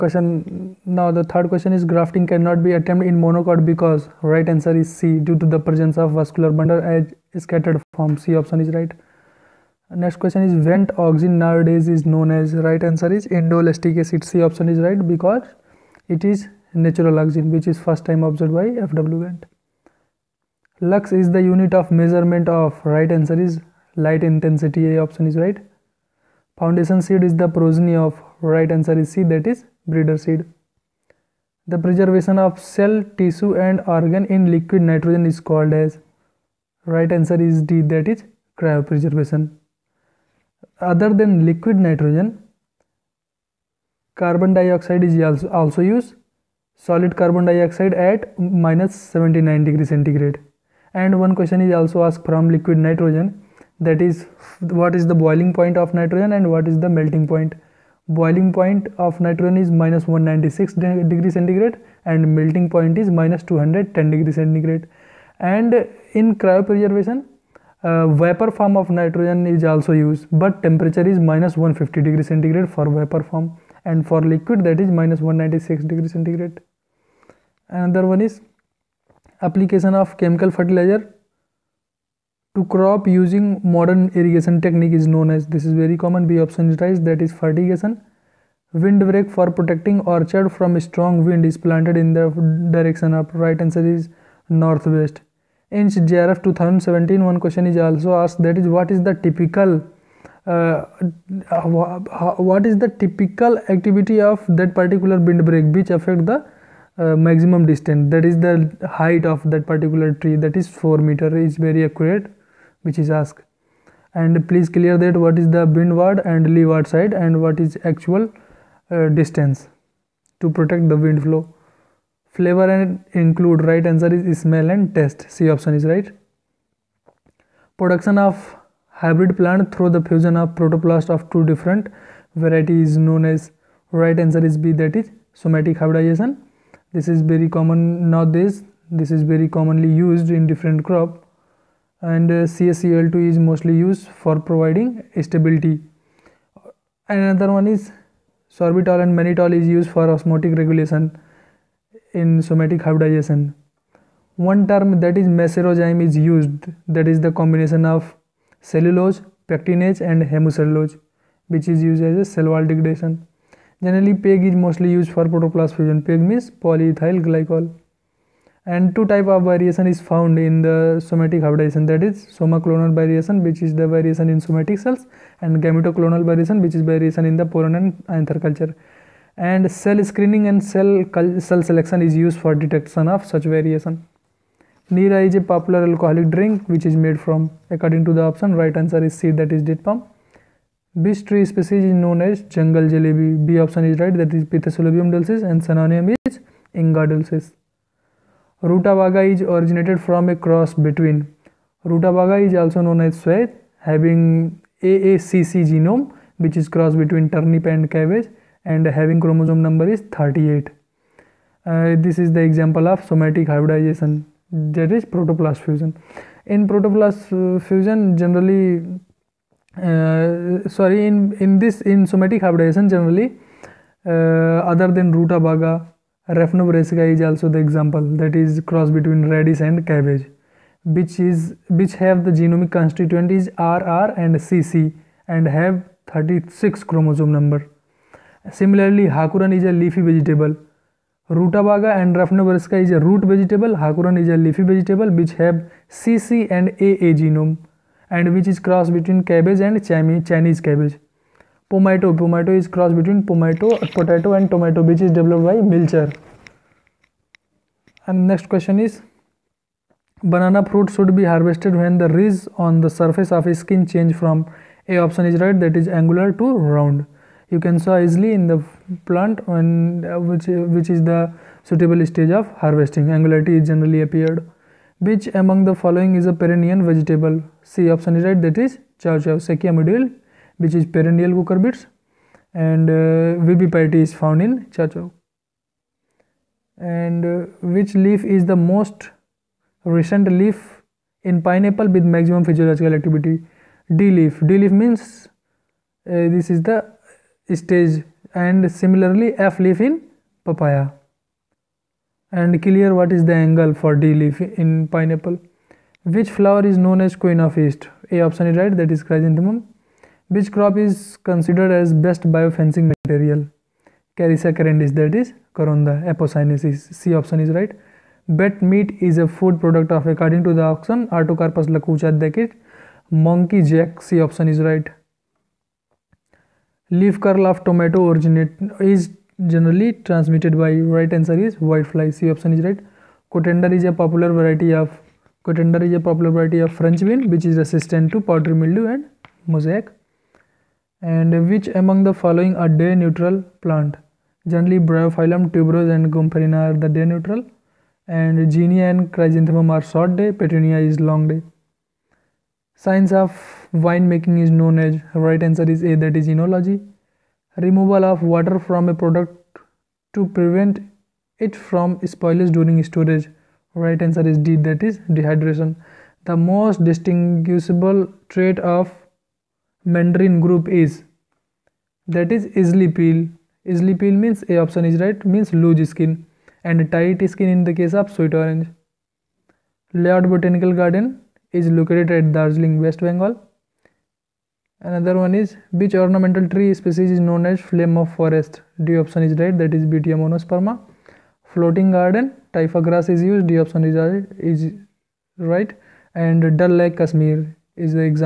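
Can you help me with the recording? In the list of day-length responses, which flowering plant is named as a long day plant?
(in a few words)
petunia.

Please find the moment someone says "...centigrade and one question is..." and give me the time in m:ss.
0:49.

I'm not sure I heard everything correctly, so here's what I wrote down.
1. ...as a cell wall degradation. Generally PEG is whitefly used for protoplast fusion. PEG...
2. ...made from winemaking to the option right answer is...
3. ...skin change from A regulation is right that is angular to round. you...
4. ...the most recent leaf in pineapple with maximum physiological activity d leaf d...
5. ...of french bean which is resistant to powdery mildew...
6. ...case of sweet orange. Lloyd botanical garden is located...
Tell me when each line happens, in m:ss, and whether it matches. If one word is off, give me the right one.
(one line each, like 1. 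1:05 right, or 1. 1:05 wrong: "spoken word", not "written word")
1. 2:42 wrong: "mostly", not "whitefly"
2. 3:06 wrong: "according", not "winemaking"
3. 4:23 wrong: "option", not "regulation"
4. 4:48 right
5. 5:36 right
6. 6:17 right.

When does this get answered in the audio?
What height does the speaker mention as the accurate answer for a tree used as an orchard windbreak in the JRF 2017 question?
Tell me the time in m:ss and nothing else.
1:50.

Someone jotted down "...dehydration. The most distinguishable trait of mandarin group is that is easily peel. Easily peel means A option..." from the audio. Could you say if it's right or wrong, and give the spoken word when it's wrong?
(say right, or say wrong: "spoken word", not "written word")
right.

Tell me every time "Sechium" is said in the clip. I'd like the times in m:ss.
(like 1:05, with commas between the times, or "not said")
4:39.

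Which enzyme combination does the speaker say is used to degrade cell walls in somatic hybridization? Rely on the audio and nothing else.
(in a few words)
macerozyme.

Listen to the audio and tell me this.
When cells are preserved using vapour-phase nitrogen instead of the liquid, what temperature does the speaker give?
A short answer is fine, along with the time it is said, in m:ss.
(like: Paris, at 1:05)
-150 degrees centigrade, at 1:11.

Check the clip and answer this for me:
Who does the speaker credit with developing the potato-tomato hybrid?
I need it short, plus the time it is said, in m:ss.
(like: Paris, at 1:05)
Milcher, at 4:15.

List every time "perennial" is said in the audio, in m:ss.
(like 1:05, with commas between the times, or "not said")
4:36, 4:40.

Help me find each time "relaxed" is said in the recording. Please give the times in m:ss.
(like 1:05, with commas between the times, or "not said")
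not said.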